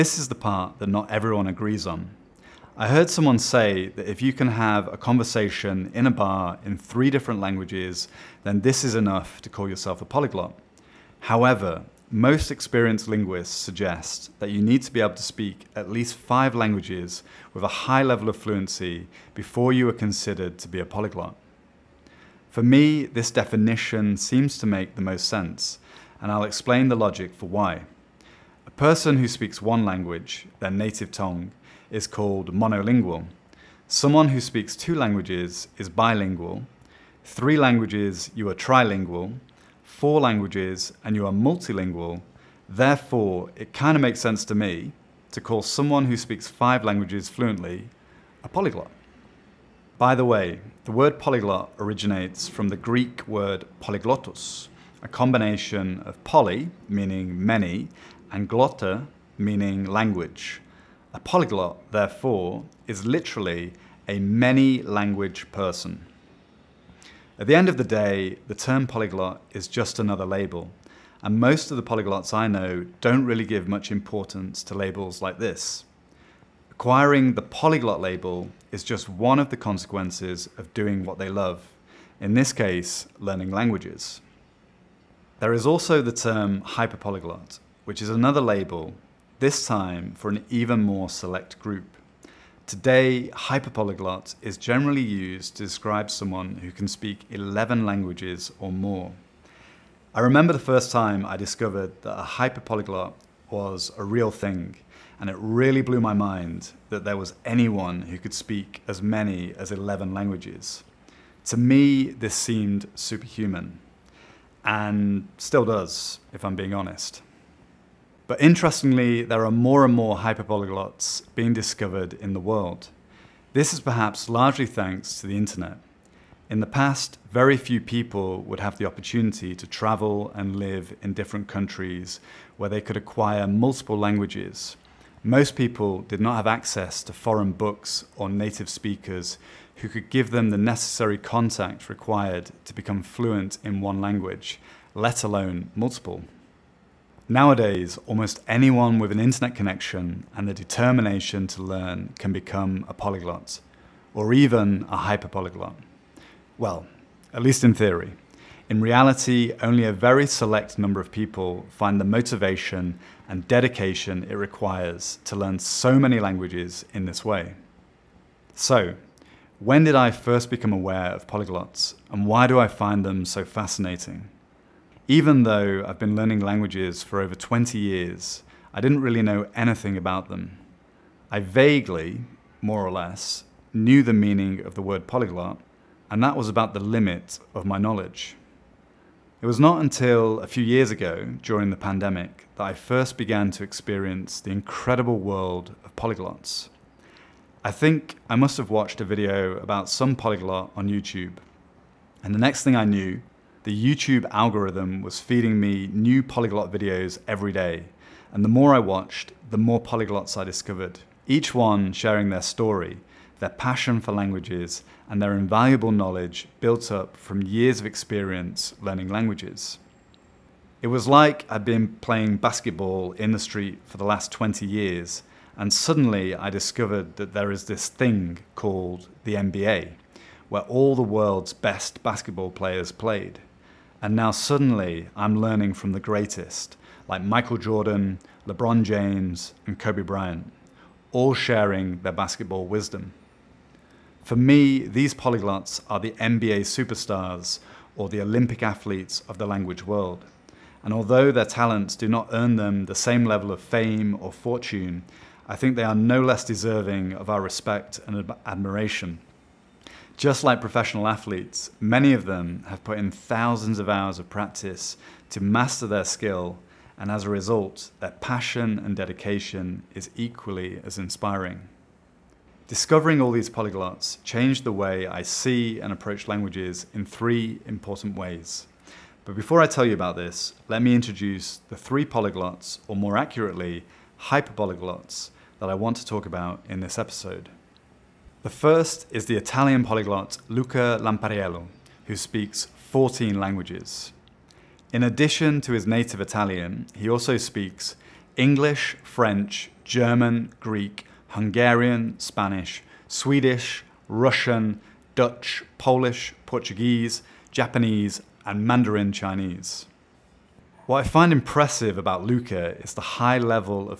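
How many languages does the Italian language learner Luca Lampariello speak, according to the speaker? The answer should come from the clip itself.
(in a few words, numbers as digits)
14.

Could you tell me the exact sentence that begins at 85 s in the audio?
There is also the term hyperpolyglot, which is another label, this time for an even more select group.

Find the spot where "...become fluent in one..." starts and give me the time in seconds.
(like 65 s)
142 s.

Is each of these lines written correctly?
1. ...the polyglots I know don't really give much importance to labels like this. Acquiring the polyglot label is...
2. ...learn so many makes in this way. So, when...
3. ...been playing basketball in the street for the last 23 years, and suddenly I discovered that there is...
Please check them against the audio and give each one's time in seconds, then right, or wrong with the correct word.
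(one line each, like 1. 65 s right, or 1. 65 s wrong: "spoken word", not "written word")
1. 71 s right
2. 165 s wrong: "languages", not "makes"
3. 221 s wrong: "20", not "23".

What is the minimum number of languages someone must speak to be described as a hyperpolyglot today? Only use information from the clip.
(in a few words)
11.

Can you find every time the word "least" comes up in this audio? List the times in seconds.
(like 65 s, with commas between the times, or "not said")
15 s, 157 s.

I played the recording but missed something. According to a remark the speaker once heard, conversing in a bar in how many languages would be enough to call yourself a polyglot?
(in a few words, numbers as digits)
3.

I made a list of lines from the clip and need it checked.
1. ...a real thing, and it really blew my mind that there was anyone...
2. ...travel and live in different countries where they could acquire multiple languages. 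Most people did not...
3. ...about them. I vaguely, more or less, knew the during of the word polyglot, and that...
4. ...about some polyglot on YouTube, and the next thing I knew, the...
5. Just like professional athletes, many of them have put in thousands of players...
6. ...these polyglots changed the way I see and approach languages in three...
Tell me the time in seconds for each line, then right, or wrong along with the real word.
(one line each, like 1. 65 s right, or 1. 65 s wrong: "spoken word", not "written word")
1. 103 s right
2. 129 s right
3. 179 s wrong: "meaning", not "during"
4. 199 s right
5. 260 s wrong: "hours", not "players"
6. 273 s right.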